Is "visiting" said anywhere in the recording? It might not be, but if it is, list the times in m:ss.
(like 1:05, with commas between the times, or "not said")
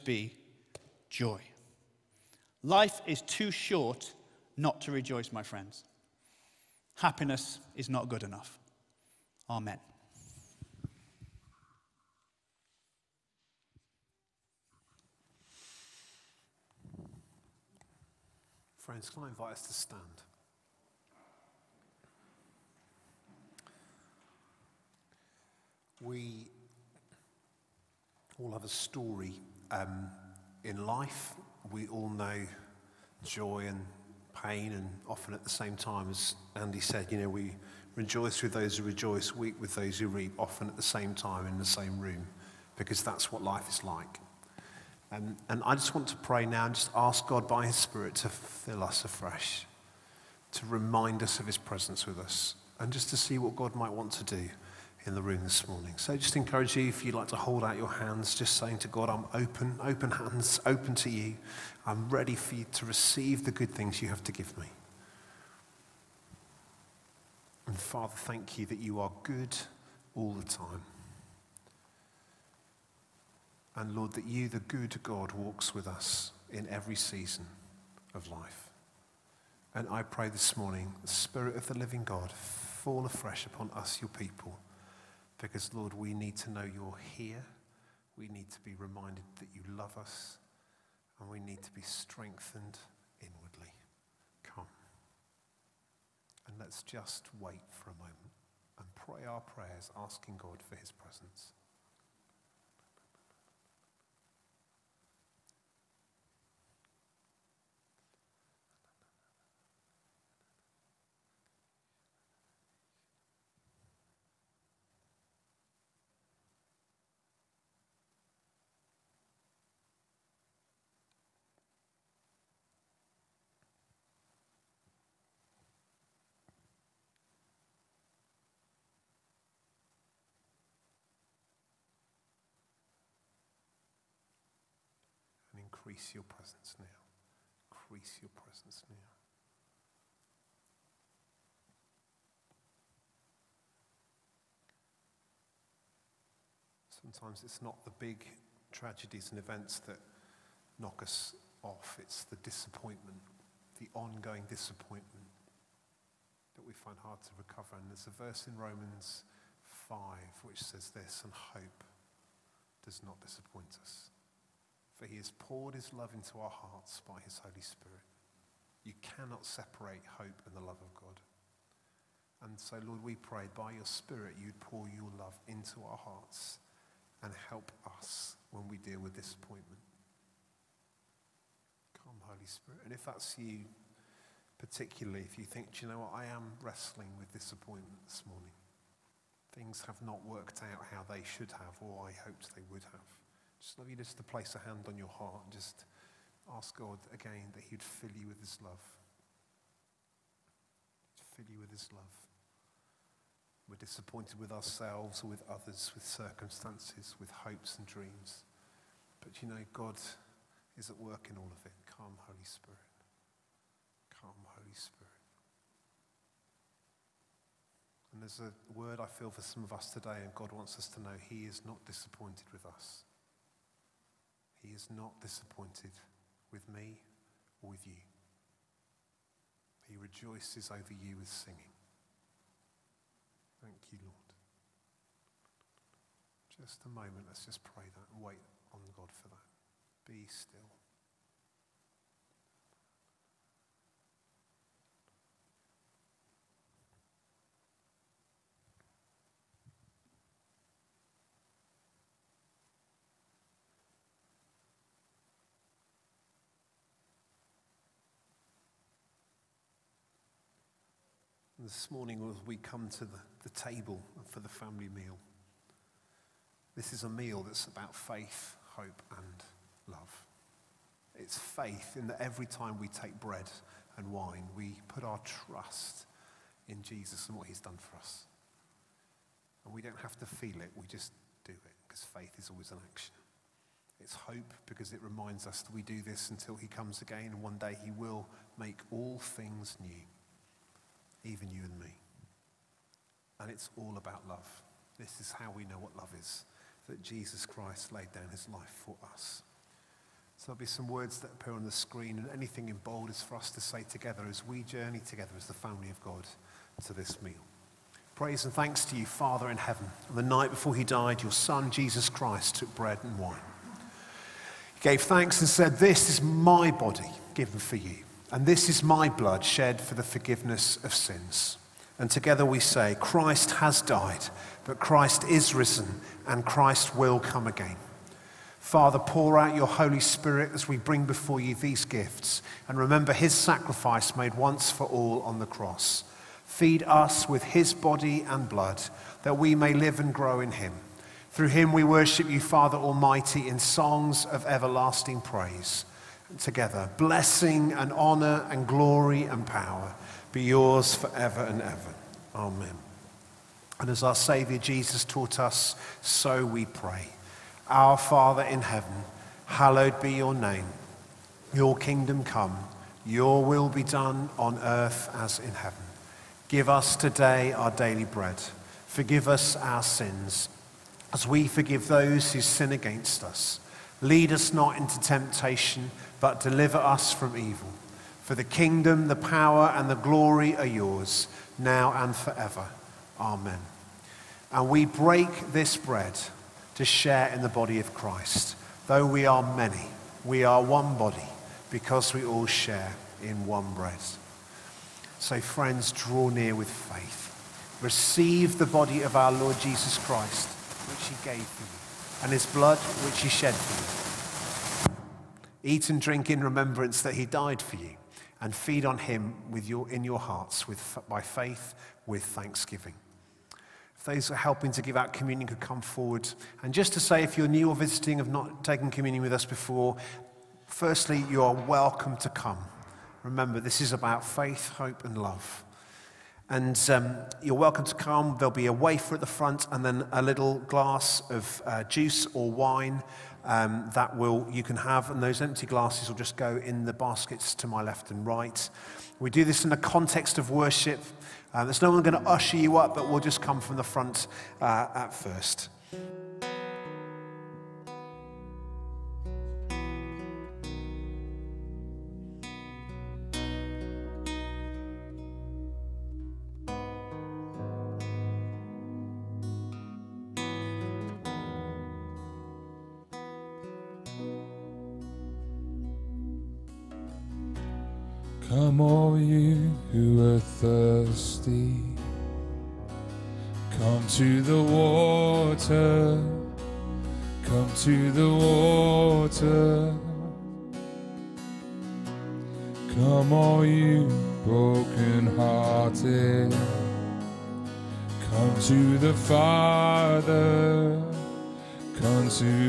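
6:57.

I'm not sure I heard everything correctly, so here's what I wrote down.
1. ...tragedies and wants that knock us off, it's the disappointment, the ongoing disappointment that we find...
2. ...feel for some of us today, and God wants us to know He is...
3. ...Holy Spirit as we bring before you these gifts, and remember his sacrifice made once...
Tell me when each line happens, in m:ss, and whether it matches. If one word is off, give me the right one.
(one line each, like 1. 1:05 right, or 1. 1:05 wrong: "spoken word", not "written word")
1. 2:28 wrong: "events", not "wants"
2. 3:39 right
3. 5:29 right.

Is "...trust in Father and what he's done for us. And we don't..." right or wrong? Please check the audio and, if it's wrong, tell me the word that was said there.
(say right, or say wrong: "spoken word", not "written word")
wrong: "Jesus", not "Father".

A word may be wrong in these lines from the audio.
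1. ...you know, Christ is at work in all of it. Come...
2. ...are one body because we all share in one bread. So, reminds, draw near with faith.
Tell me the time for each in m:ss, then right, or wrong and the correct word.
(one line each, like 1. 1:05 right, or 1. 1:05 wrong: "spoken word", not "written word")
1. 3:29 wrong: "God", not "Christ"
2. 6:30 wrong: "friends", not "reminds".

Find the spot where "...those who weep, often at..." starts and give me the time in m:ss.
0:39.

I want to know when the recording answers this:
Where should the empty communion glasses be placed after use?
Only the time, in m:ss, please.
7:16.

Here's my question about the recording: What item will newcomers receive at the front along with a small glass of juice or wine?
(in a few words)
A wafer.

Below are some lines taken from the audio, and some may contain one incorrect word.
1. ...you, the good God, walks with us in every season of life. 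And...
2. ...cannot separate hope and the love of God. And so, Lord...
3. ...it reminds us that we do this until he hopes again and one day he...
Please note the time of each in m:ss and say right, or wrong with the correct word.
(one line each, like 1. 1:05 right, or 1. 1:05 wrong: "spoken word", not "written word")
1. 1:14 right
2. 2:49 right
3. 4:44 wrong: "comes", not "hopes".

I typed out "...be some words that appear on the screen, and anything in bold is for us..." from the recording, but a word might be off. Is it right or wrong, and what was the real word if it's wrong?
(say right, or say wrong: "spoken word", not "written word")
right.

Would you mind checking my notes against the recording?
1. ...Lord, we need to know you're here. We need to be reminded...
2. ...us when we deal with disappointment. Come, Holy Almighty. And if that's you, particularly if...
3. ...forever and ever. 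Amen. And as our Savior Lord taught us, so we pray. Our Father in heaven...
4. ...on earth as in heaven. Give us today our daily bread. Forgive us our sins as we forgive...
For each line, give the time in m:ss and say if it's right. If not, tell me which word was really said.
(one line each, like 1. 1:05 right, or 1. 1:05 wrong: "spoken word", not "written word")
1. 1:25 right
2. 2:57 wrong: "Spirit", not "Almighty"
3. 5:50 wrong: "Jesus", not "Lord"
4. 6:04 right.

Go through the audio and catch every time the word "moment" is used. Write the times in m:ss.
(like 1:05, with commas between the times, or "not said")
1:37, 3:56.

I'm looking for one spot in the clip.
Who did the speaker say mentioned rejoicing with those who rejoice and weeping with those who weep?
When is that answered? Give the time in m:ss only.
0:36.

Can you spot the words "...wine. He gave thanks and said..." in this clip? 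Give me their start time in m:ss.
5:13.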